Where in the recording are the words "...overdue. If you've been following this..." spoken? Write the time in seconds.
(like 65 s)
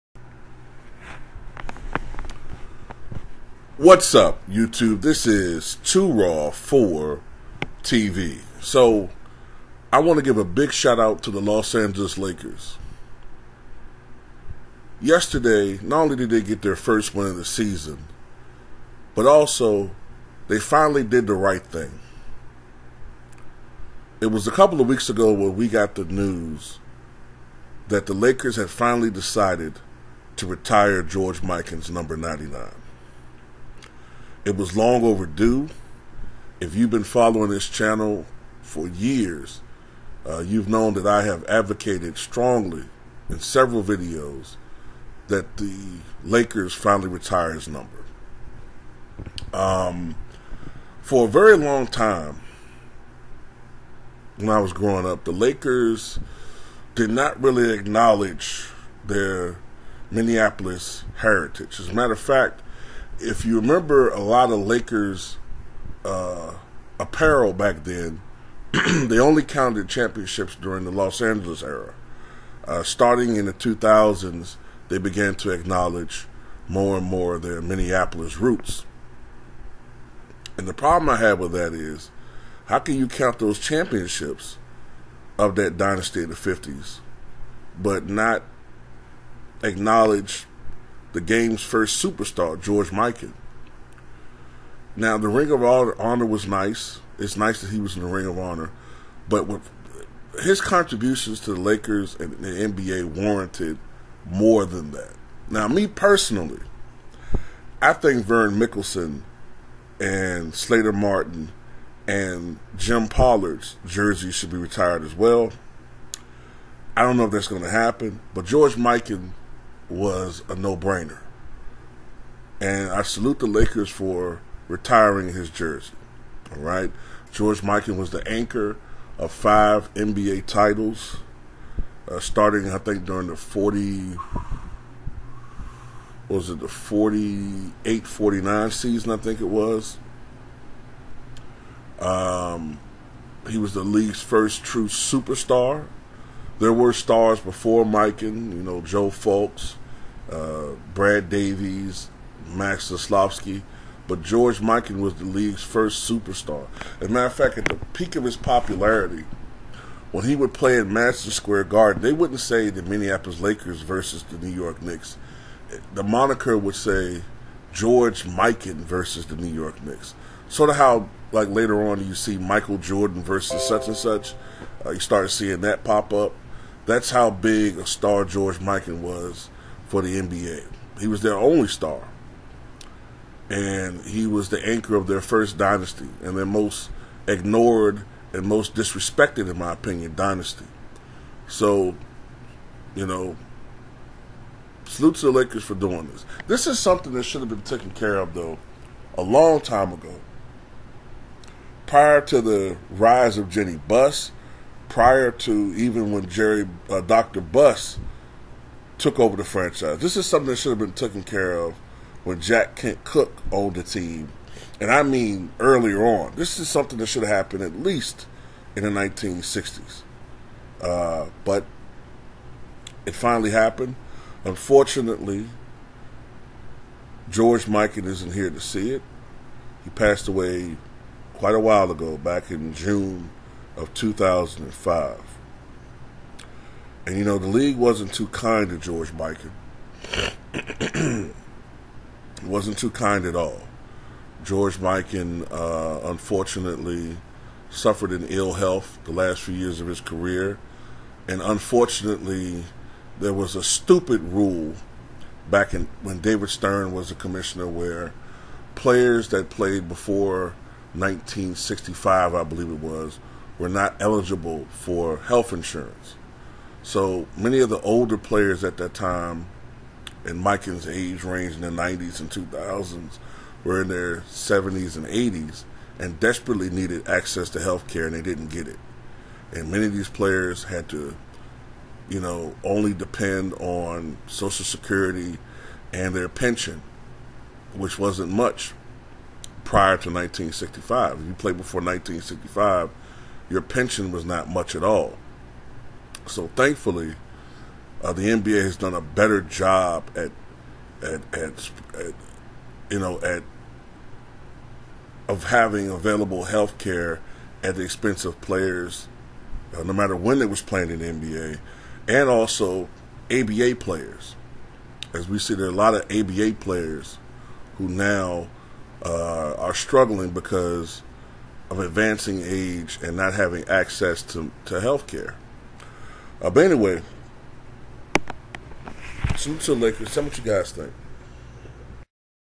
35 s.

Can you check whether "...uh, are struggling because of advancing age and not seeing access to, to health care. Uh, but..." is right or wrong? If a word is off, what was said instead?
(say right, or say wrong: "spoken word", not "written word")
wrong: "having", not "seeing".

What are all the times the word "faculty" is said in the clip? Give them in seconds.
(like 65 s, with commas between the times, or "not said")
not said.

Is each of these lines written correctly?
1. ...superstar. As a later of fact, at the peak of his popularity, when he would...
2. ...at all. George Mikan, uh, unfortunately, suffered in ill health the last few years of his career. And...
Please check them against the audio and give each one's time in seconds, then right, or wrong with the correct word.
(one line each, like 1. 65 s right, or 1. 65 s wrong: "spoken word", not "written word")
1. 156 s wrong: "matter", not "later"
2. 243 s right.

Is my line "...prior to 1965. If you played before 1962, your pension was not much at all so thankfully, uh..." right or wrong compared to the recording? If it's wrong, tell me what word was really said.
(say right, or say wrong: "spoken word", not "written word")
wrong: "1965", not "1962".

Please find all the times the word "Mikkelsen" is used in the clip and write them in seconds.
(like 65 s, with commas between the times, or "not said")
108 s.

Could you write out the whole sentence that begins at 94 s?
Now, the Ring of Honor was nice.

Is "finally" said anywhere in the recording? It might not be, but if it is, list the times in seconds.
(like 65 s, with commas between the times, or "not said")
20 s, 28 s, 46 s, 223 s.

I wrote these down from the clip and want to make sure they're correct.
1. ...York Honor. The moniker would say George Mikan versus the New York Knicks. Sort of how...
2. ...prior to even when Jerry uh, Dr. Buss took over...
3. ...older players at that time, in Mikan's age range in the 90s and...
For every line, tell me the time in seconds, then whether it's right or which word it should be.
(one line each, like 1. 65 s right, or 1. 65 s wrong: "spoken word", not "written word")
1. 164 s wrong: "Knicks", not "Honor"
2. 204 s right
3. 267 s right.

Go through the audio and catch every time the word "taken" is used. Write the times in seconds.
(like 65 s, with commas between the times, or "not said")
197 s, 210 s.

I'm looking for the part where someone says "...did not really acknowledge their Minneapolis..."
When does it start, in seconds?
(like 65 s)
56 s.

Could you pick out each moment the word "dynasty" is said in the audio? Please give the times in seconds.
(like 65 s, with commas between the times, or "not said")
85 s, 185 s, 190 s.